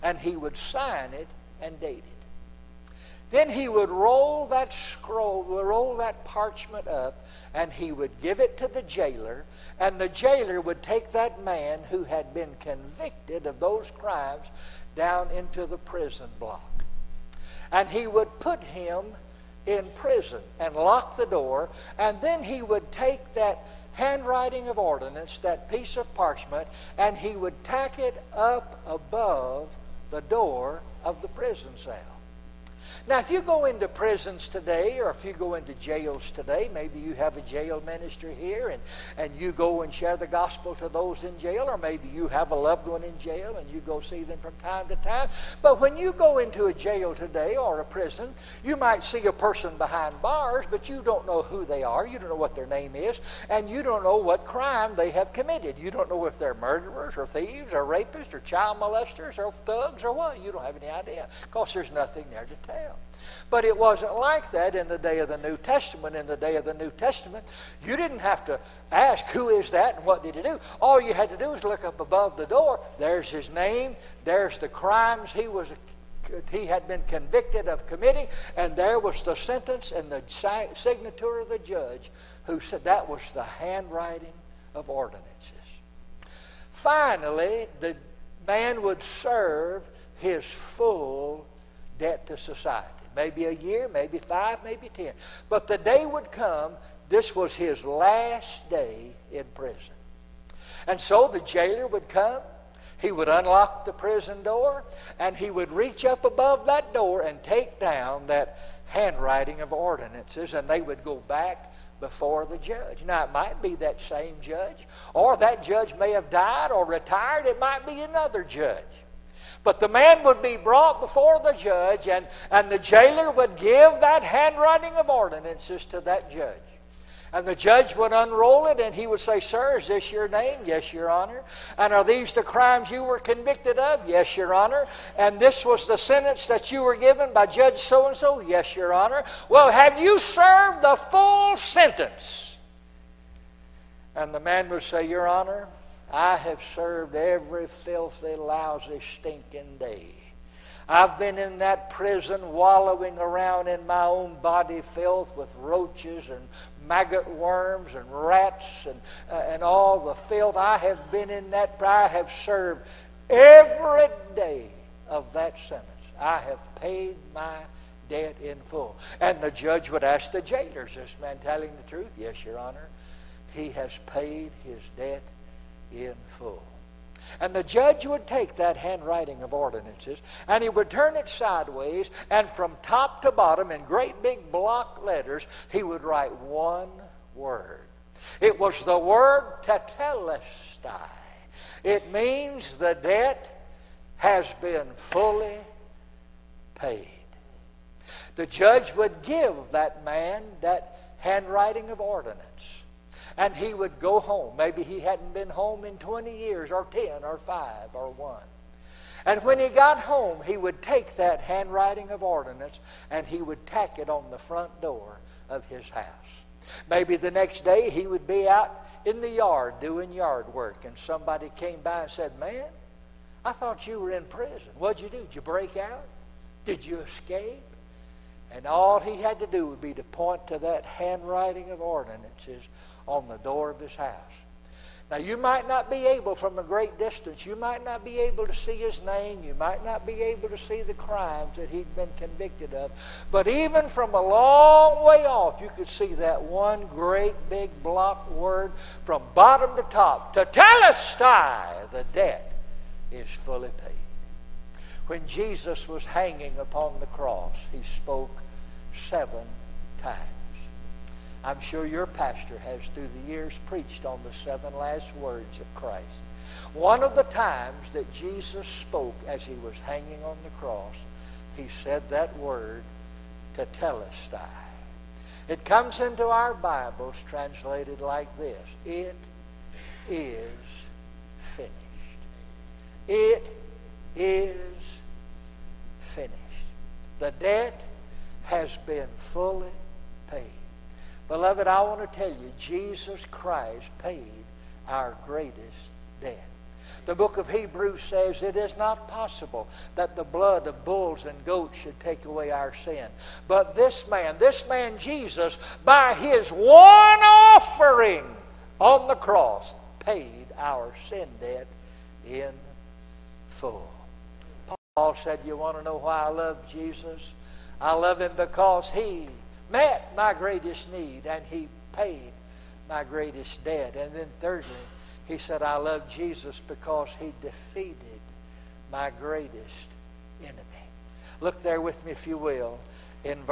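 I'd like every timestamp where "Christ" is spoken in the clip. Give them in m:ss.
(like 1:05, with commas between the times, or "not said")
4:25, 4:53.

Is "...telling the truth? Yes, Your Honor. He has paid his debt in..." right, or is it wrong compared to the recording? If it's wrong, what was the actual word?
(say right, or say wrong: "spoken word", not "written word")
right.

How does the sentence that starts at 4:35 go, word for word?
It comes into our Bibles translated like this It is finished.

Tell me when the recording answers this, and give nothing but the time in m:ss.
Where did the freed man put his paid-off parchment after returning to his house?
3:34.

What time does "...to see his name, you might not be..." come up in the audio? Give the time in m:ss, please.
3:58.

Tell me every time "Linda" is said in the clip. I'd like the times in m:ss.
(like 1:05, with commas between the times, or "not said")
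not said.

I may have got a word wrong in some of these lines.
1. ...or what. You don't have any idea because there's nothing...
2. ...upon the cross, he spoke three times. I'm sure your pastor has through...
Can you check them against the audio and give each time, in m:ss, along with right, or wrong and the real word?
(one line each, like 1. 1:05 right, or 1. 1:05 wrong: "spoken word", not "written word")
1. 1:00 right
2. 4:16 wrong: "seven", not "three".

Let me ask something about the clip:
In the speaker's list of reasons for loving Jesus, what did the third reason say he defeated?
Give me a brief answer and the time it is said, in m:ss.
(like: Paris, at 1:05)
My greatest enemy, at 5:28.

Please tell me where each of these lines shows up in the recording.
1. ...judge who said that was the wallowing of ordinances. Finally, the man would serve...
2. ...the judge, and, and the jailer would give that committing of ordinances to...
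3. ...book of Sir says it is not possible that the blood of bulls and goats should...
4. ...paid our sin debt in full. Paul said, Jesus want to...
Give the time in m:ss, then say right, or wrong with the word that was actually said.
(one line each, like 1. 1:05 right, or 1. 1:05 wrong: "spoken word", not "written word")
1. 1:21 wrong: "handwriting", not "wallowing"
2. 2:01 wrong: "handwriting", not "committing"
3. 4:57 wrong: "Hebrews", not "Sir"
4. 5:10 wrong: "You", not "Jesus".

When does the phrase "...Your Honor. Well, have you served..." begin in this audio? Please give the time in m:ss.
2:18.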